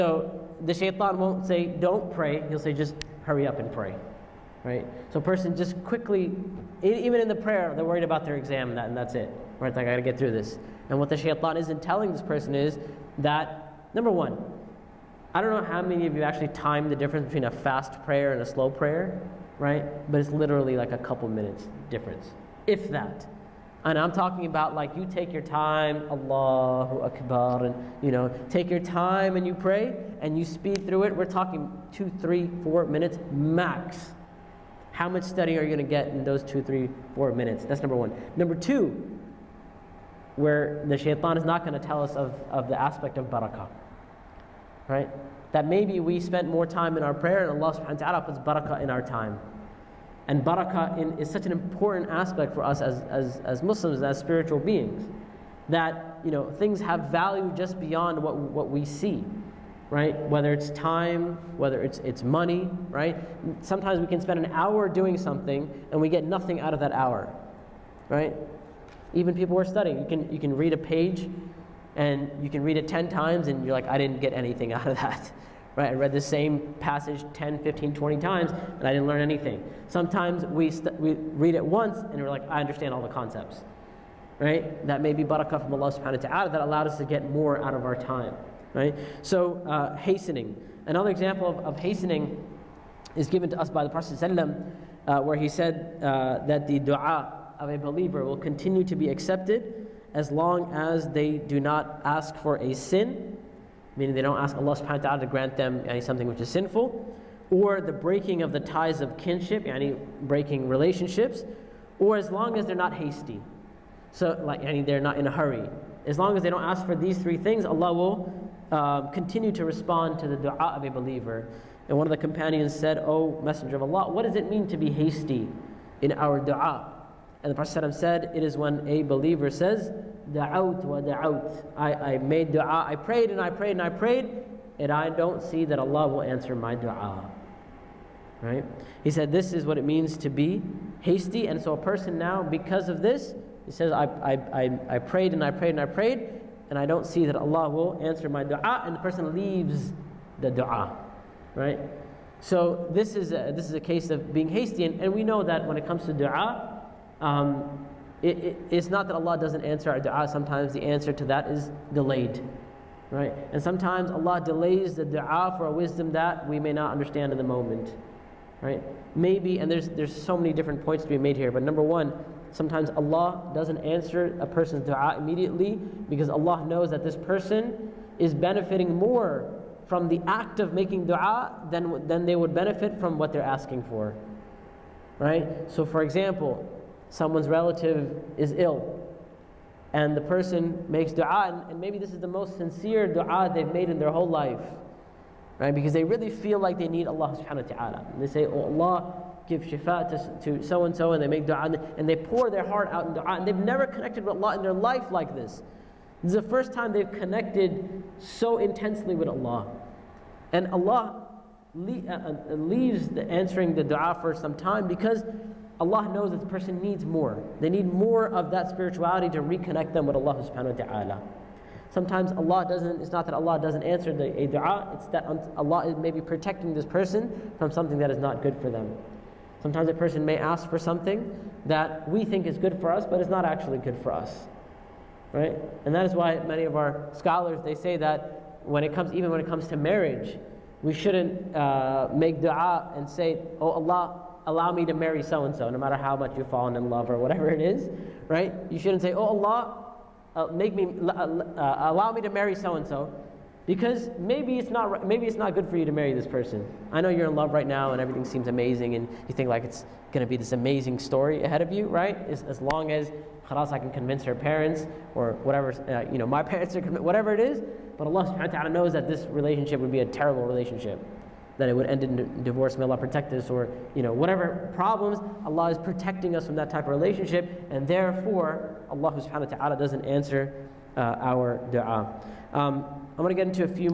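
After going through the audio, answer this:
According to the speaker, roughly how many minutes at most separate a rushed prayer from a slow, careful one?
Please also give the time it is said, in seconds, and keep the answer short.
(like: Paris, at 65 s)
4 minutes, at 32 s.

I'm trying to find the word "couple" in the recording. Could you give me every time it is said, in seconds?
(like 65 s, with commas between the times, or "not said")
20 s.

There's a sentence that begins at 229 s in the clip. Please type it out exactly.
Sometimes a person may ask for something that we think is good for us, but it's not actually good for us.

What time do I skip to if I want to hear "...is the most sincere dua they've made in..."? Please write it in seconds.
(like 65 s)
192 s.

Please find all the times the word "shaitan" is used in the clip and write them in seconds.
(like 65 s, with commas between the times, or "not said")
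0 s, 11 s, 40 s.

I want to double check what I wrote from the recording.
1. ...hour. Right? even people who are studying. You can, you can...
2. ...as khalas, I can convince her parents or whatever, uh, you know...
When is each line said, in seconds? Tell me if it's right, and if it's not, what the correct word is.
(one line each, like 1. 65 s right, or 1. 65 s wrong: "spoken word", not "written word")
1. 66 s right
2. 262 s right.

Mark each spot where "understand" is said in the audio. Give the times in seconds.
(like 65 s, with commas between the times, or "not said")
82 s, 166 s.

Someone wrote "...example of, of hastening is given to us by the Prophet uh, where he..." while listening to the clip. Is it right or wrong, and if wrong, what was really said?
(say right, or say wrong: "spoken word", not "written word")
right.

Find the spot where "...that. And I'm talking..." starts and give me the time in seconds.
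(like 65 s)
22 s.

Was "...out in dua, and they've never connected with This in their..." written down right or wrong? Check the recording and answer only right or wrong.
wrong.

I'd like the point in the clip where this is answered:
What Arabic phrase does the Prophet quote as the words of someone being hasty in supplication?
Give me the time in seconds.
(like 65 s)
130 s.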